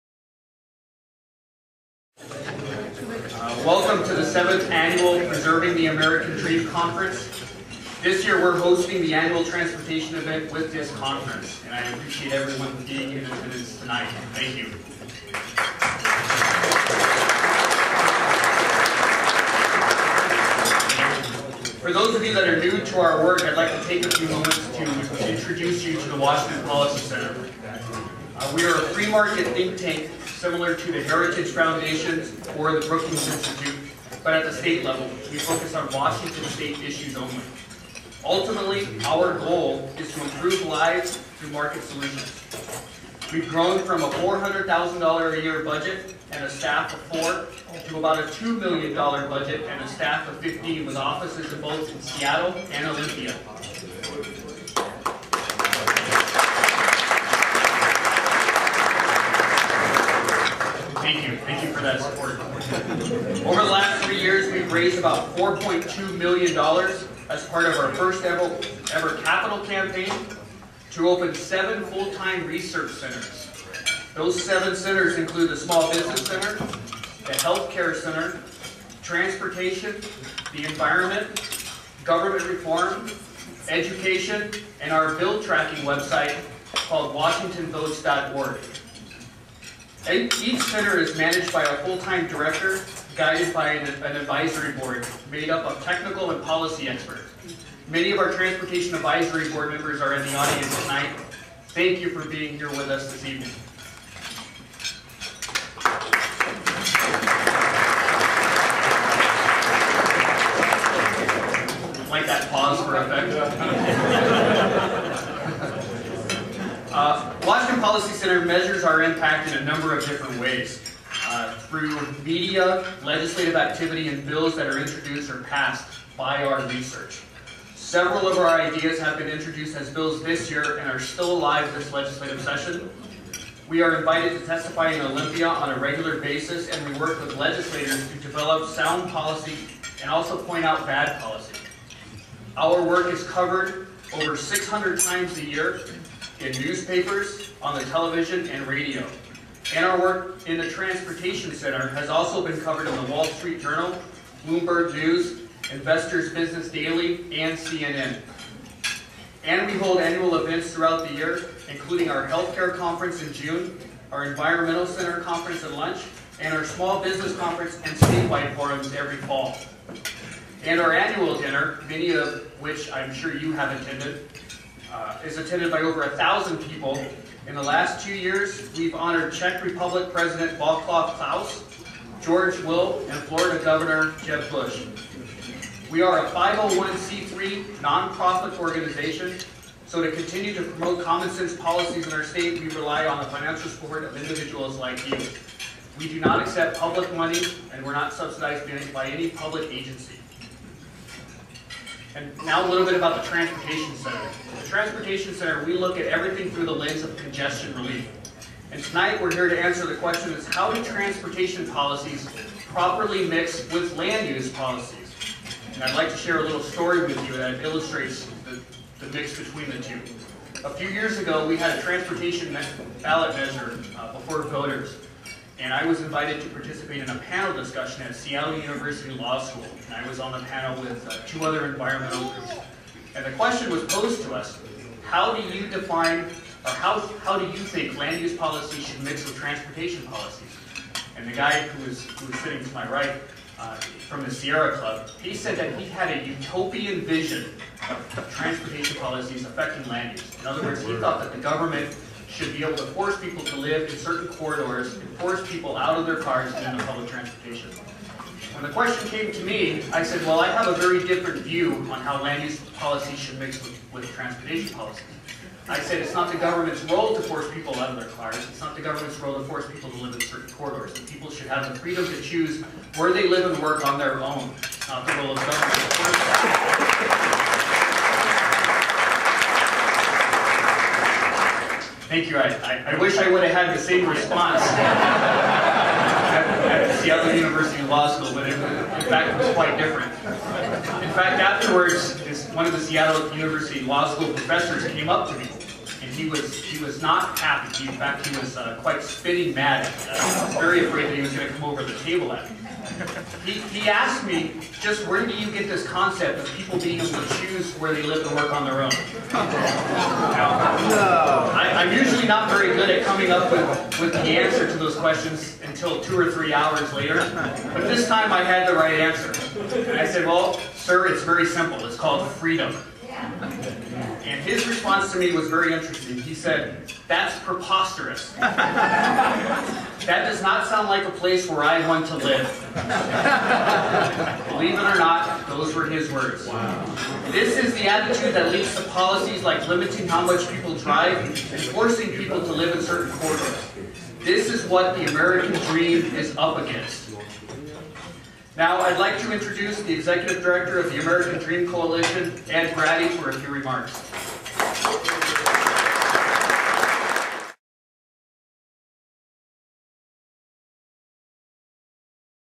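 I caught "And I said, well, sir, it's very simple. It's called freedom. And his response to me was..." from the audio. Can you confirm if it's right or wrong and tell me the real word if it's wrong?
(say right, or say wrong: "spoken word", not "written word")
right.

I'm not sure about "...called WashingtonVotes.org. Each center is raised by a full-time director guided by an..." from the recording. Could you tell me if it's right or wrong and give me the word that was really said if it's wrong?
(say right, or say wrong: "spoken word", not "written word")
wrong: "managed", not "raised".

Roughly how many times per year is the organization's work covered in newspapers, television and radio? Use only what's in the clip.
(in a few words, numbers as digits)
600.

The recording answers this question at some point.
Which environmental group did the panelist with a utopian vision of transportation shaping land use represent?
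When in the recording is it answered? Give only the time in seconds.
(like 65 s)
244 s.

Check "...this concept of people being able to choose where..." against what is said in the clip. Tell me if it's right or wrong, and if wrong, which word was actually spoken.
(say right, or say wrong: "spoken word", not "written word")
right.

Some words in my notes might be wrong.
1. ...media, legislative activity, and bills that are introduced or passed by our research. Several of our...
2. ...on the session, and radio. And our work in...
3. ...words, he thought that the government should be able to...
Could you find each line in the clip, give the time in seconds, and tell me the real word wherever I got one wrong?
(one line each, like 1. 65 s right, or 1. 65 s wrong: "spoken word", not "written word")
1. 122 s right
2. 147 s wrong: "television", not "session"
3. 250 s right.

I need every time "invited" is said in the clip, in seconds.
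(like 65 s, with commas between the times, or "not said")
133 s, 226 s.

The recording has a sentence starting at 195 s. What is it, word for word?
We do not accept public money, and we're not subsidized by any public agency.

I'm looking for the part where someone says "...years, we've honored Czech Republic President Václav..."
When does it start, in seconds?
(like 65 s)
178 s.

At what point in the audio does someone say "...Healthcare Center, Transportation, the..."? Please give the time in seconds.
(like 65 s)
77 s.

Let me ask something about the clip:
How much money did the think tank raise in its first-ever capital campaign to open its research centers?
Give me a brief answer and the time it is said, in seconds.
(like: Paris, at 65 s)
$4.2 million, at 65 s.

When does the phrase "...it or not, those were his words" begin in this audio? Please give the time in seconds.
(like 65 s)
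334 s.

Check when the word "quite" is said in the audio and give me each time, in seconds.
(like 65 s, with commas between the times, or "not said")
289 s, 298 s.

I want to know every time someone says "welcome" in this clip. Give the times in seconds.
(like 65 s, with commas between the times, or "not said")
3 s.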